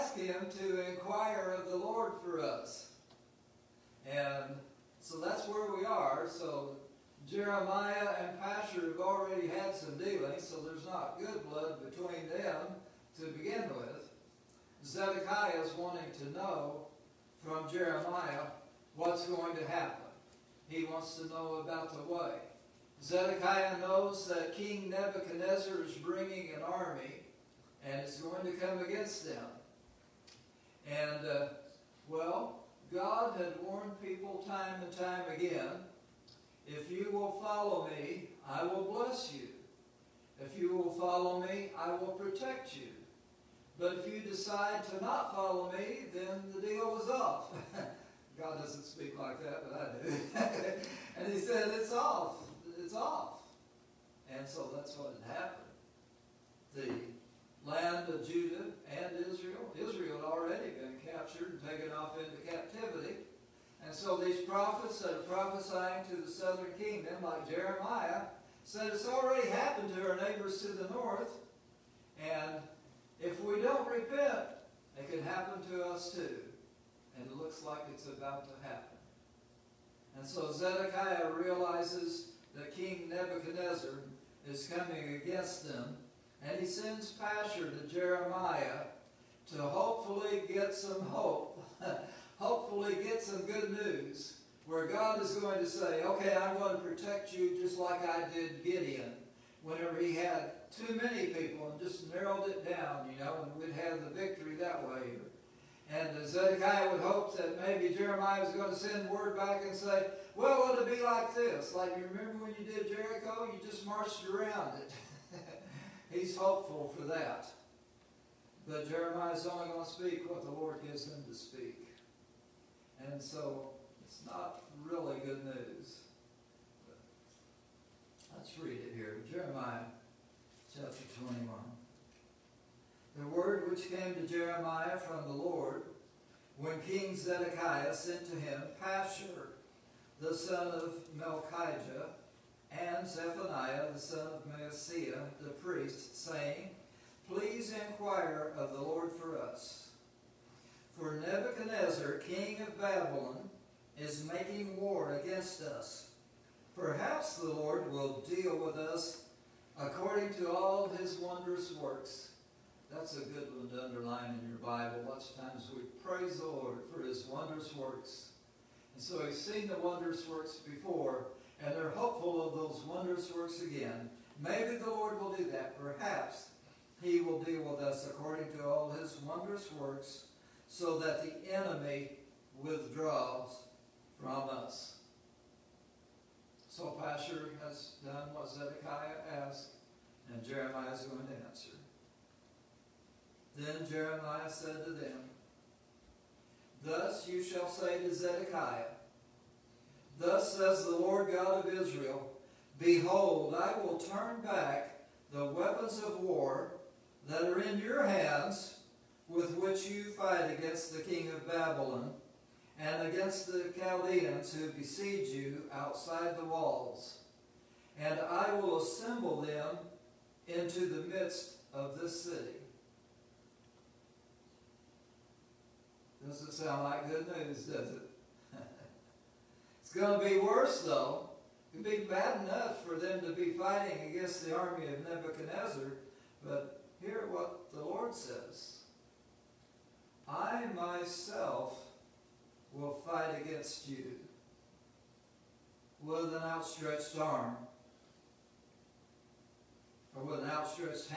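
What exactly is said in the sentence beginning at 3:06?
So Pashur has done what Zedekiah asked, and Jeremiah is going to answer.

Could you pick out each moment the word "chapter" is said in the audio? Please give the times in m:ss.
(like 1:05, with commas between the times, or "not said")
2:10.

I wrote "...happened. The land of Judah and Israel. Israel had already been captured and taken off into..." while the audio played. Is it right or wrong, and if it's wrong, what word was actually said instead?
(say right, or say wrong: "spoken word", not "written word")
right.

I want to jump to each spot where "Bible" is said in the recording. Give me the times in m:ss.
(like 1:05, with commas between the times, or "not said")
2:44.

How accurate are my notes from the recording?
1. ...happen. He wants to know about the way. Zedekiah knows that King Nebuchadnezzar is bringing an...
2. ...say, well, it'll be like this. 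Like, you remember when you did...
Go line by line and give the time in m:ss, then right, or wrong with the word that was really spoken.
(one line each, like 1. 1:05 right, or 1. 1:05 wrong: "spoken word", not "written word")
1. 0:19 right
2. 1:49 right.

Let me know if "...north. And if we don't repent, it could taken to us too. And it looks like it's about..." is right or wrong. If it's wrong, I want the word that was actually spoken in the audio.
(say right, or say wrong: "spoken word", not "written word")
wrong: "happen", not "taken".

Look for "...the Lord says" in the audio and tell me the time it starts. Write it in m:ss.
3:57.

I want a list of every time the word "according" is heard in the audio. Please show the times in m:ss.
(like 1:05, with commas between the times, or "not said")
2:39, 2:58.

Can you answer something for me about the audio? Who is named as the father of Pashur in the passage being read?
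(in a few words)
Melchijah.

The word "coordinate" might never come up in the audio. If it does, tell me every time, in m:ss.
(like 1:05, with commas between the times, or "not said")
not said.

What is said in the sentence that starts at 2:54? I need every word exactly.
Maybe the Lord will do that.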